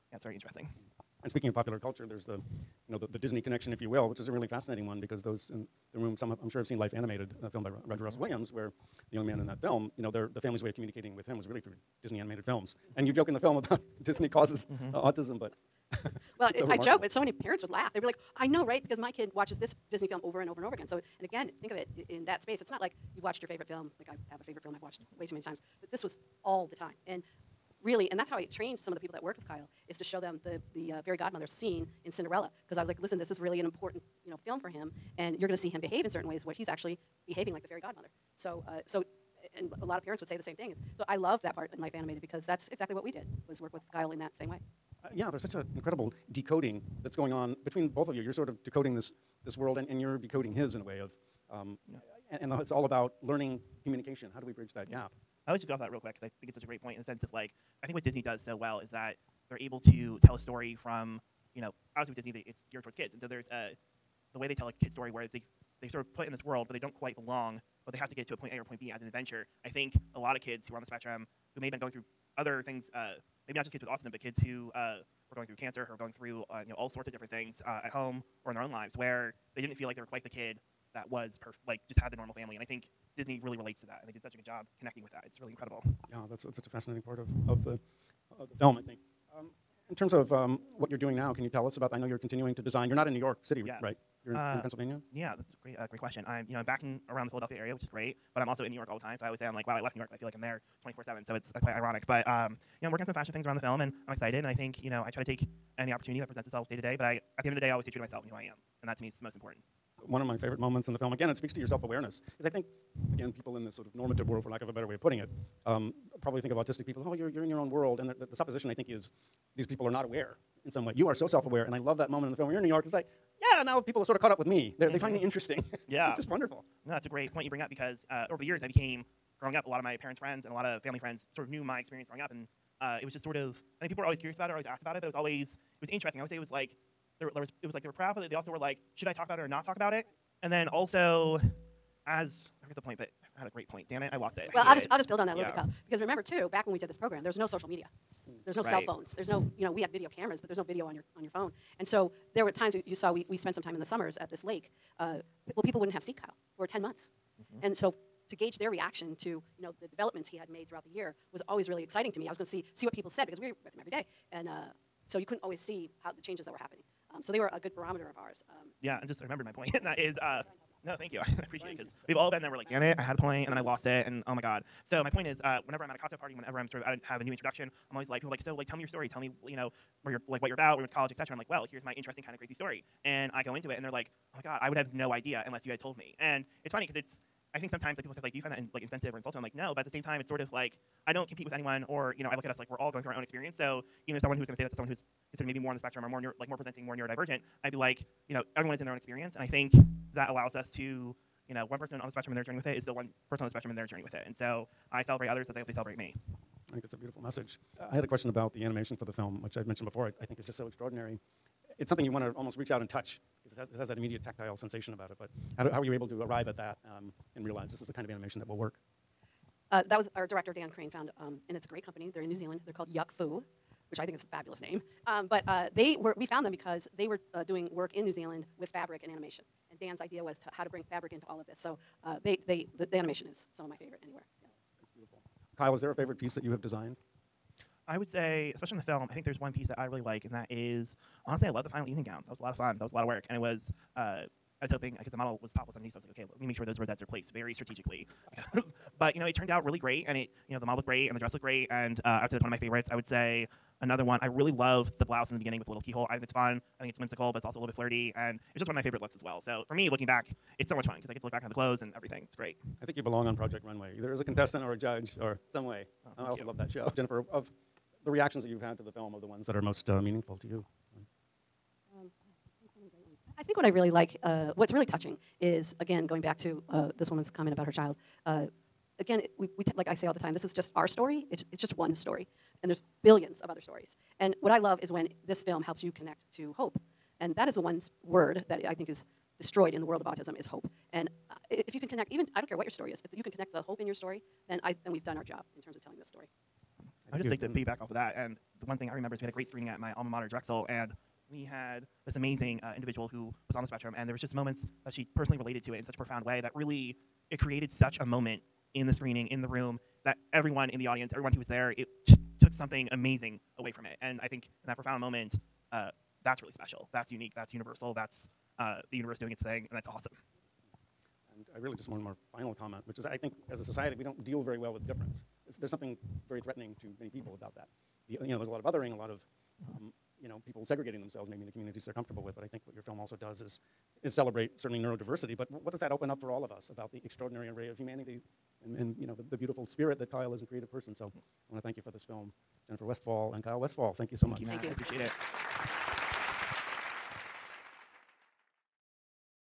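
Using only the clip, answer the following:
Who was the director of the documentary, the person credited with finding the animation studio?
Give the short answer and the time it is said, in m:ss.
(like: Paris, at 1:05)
Dan Crane, at 3:40.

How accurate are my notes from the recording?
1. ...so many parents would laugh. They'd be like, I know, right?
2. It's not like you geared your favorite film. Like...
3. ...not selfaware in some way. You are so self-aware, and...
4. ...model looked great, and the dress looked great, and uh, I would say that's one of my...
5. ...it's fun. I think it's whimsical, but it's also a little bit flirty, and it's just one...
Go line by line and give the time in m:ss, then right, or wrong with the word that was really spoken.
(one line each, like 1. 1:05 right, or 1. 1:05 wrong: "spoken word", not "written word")
1. 0:17 right
2. 0:22 wrong: "watched", not "geared"
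3. 1:59 wrong: "aware", not "selfaware"
4. 4:10 right
5. 4:16 right.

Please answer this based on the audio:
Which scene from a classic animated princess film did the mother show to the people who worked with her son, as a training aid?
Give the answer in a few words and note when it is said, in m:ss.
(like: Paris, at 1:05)
Fairy godmother scene, at 0:31.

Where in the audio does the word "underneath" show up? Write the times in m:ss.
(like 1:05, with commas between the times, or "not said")
4:05.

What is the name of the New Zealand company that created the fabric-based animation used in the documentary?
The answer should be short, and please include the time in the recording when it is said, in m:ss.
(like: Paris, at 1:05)
Yuck Foo, at 3:42.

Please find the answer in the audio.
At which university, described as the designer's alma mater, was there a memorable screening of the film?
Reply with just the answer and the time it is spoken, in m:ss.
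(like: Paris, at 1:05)
Drexel, at 5:00.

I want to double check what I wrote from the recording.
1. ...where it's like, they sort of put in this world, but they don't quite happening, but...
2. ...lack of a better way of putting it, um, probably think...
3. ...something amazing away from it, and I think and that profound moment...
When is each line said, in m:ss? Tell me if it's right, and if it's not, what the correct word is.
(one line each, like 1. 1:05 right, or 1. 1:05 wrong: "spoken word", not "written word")
1. 1:05 wrong: "belong", not "happening"
2. 1:54 right
3. 5:12 right.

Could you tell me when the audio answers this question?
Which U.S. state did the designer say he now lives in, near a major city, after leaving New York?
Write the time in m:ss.
1:34.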